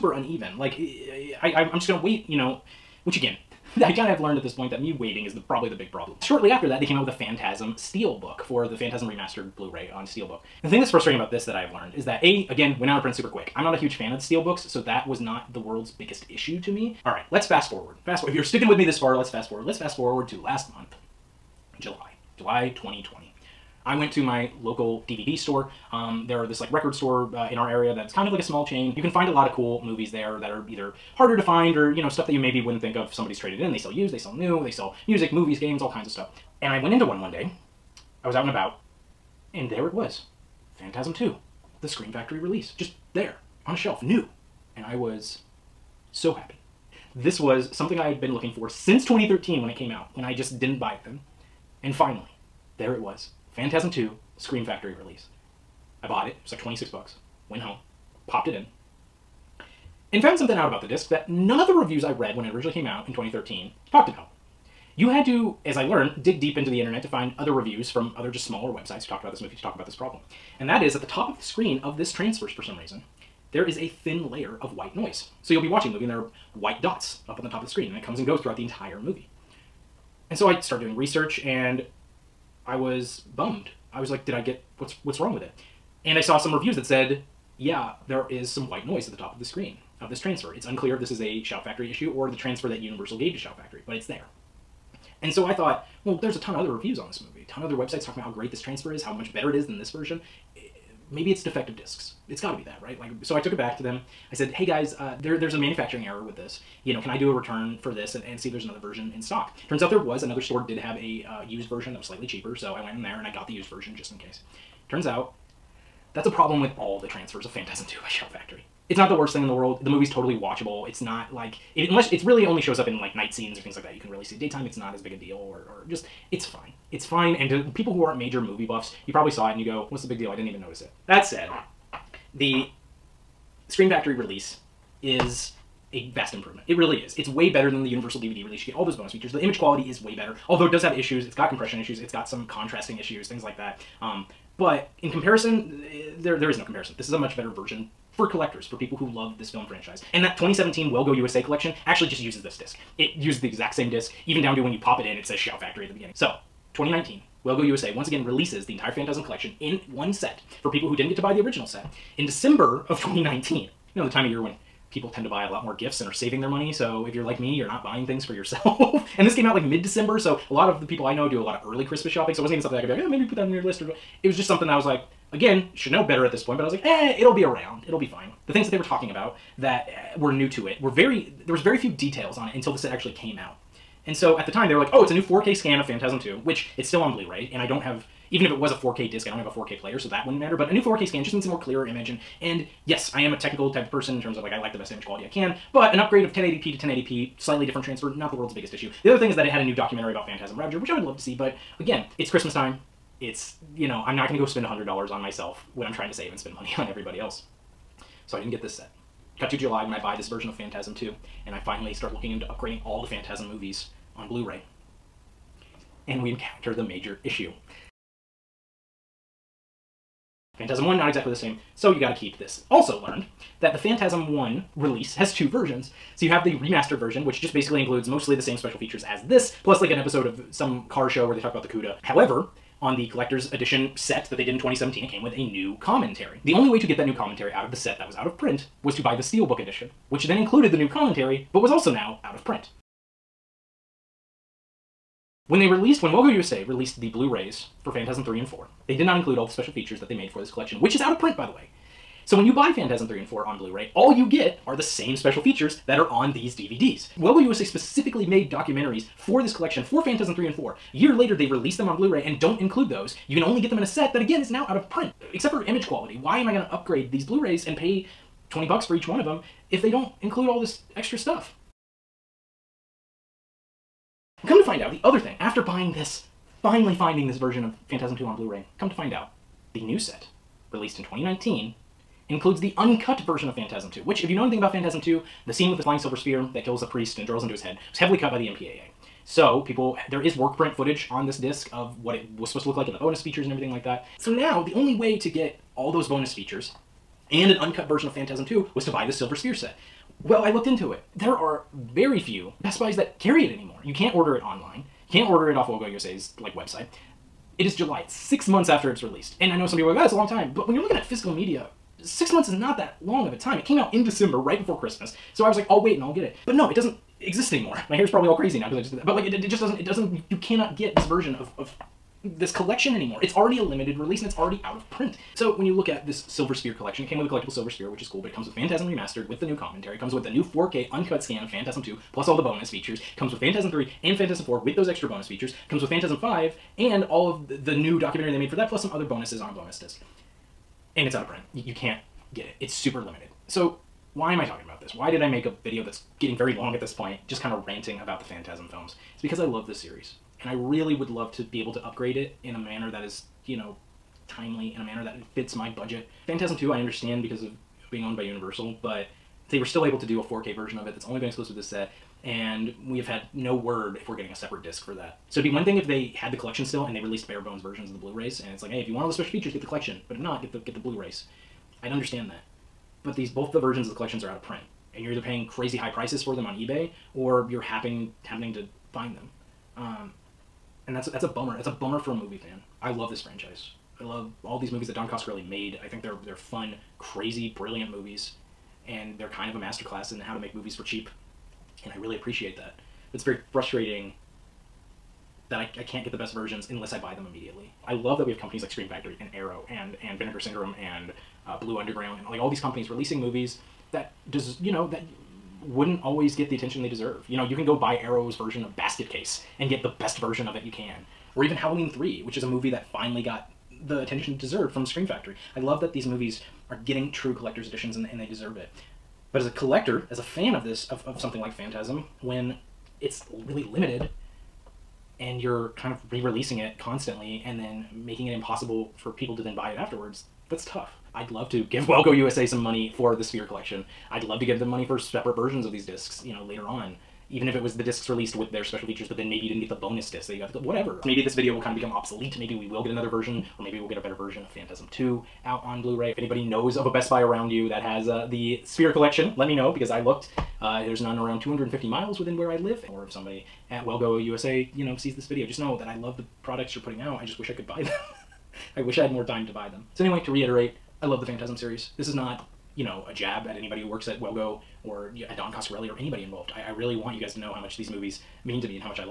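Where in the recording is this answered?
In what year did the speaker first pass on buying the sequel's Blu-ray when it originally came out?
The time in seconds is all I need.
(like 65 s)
48 s.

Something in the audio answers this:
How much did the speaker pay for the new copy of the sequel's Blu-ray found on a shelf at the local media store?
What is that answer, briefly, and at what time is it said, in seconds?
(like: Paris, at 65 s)
26 bucks, at 56 s.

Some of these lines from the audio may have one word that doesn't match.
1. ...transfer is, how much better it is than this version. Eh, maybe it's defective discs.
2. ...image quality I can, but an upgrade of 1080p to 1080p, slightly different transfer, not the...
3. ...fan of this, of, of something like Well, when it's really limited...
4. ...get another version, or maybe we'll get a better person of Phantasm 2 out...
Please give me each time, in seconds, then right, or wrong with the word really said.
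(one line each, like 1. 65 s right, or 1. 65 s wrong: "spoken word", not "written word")
1. 98 s right
2. 194 s right
3. 420 s wrong: "Phantasm", not "Well"
4. 442 s wrong: "version", not "person".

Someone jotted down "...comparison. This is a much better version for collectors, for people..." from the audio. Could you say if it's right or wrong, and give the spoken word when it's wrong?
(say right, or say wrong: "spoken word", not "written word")
right.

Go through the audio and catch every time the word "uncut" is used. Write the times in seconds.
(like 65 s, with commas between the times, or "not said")
282 s, 297 s, 330 s.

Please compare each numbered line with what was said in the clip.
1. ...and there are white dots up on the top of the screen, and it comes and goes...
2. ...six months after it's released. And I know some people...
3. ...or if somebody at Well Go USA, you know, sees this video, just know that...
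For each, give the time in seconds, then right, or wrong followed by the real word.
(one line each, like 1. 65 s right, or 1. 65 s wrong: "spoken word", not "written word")
1. 76 s right
2. 308 s right
3. 452 s right.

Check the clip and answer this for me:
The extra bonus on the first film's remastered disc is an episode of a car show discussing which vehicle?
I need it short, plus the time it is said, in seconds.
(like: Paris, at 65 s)
the Cuda, at 231 s.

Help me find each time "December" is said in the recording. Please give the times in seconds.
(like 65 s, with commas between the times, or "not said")
162 s, 169 s, 314 s.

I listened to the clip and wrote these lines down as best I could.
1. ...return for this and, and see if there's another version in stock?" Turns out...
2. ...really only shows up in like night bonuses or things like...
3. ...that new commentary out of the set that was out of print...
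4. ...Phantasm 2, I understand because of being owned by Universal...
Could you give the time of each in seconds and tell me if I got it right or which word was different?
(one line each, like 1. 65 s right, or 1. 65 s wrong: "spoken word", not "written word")
1. 107 s right
2. 122 s wrong: "scenes", not "bonuses"
3. 236 s right
4. 356 s right.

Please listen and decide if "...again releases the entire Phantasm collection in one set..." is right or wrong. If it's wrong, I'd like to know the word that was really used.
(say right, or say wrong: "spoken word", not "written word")
right.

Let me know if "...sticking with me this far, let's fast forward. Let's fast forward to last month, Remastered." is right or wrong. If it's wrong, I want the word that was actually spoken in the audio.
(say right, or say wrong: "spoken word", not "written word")
wrong: "July", not "Remastered".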